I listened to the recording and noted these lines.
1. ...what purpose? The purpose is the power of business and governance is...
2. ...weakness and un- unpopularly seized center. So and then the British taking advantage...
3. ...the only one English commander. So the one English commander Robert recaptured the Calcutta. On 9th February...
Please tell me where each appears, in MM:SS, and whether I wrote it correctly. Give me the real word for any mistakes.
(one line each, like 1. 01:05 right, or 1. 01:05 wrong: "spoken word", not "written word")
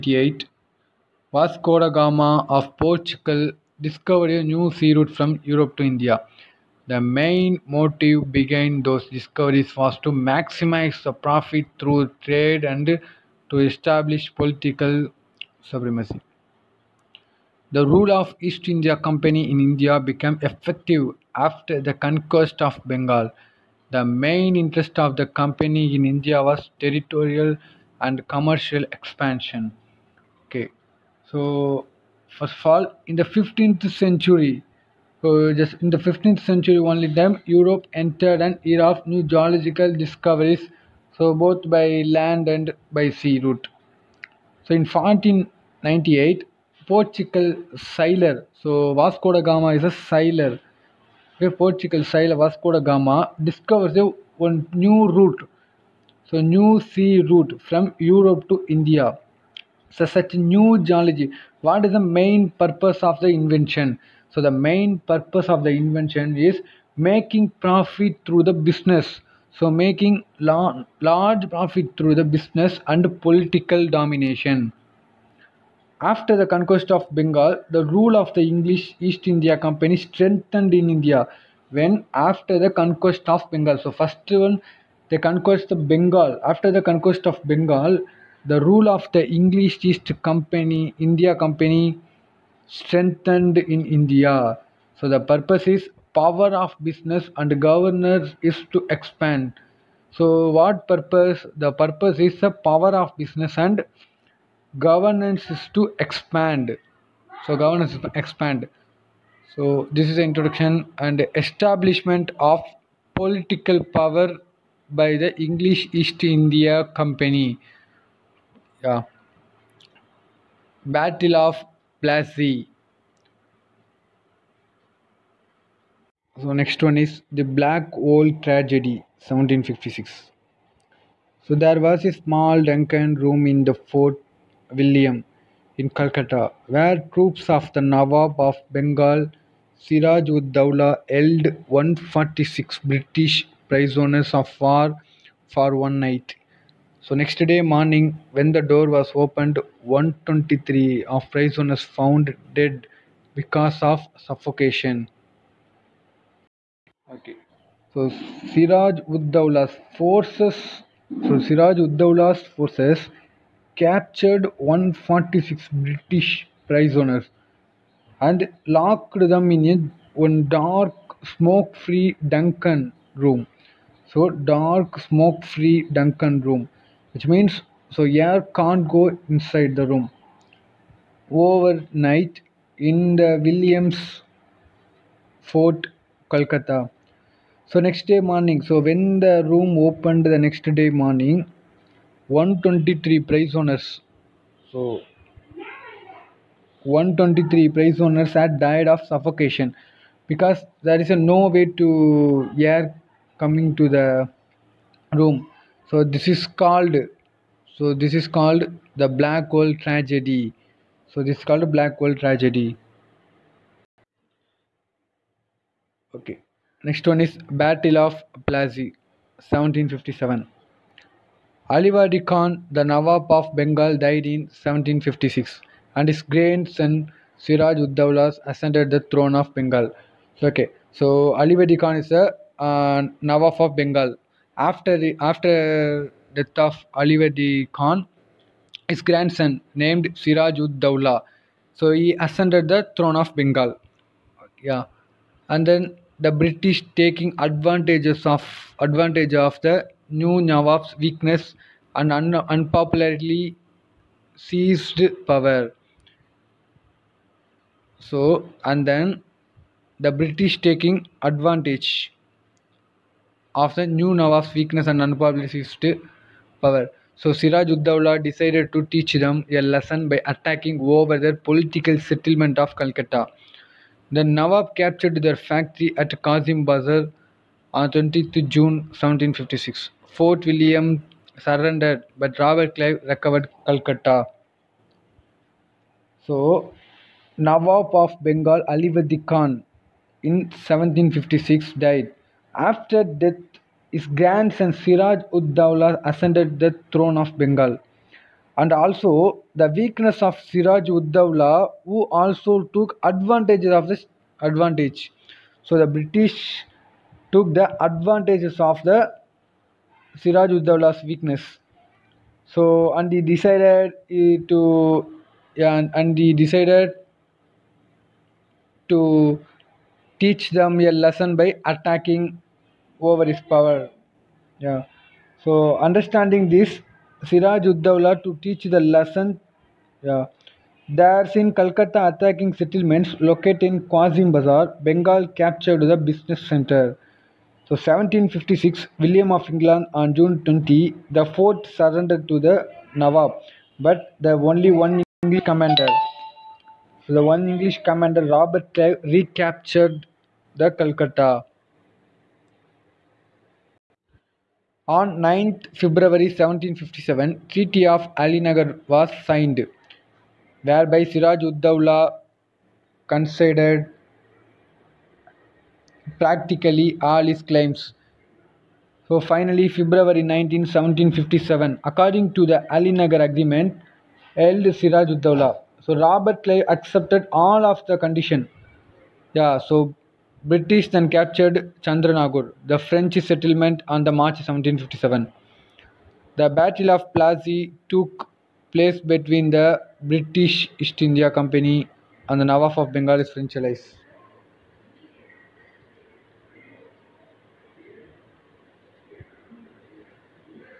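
1. 01:40 right
2. 04:10 wrong: "power", not "center"
3. 05:44 right.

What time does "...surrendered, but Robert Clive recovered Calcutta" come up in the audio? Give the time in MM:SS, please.
04:41.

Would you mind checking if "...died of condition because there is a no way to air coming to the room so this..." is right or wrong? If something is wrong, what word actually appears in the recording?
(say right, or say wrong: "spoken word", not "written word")
wrong: "suffocation", not "condition".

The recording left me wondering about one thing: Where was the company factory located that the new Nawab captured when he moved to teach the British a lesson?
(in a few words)
Kazim Bazar.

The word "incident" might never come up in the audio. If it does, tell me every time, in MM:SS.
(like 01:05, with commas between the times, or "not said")
not said.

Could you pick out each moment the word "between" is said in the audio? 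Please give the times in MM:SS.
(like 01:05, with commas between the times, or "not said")
06:28.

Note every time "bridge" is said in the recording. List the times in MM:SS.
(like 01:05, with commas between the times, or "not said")
not said.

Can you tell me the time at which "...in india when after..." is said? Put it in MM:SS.
01:20.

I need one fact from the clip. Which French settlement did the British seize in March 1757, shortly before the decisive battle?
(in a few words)
Chandranagore.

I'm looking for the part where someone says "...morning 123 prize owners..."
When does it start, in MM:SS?
03:10.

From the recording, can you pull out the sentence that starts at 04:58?
And also, the weakness of Siraj ud Daula, who also took advantage of this advantage.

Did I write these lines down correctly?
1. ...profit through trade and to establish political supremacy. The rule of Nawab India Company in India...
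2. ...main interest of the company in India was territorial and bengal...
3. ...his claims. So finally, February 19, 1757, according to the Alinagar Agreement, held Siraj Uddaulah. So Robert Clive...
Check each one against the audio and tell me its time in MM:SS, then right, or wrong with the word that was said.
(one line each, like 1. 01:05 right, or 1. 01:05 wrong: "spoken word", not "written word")
1. 00:11 wrong: "East", not "Nawab"
2. 00:24 wrong: "commercial", not "bengal"
3. 06:07 right.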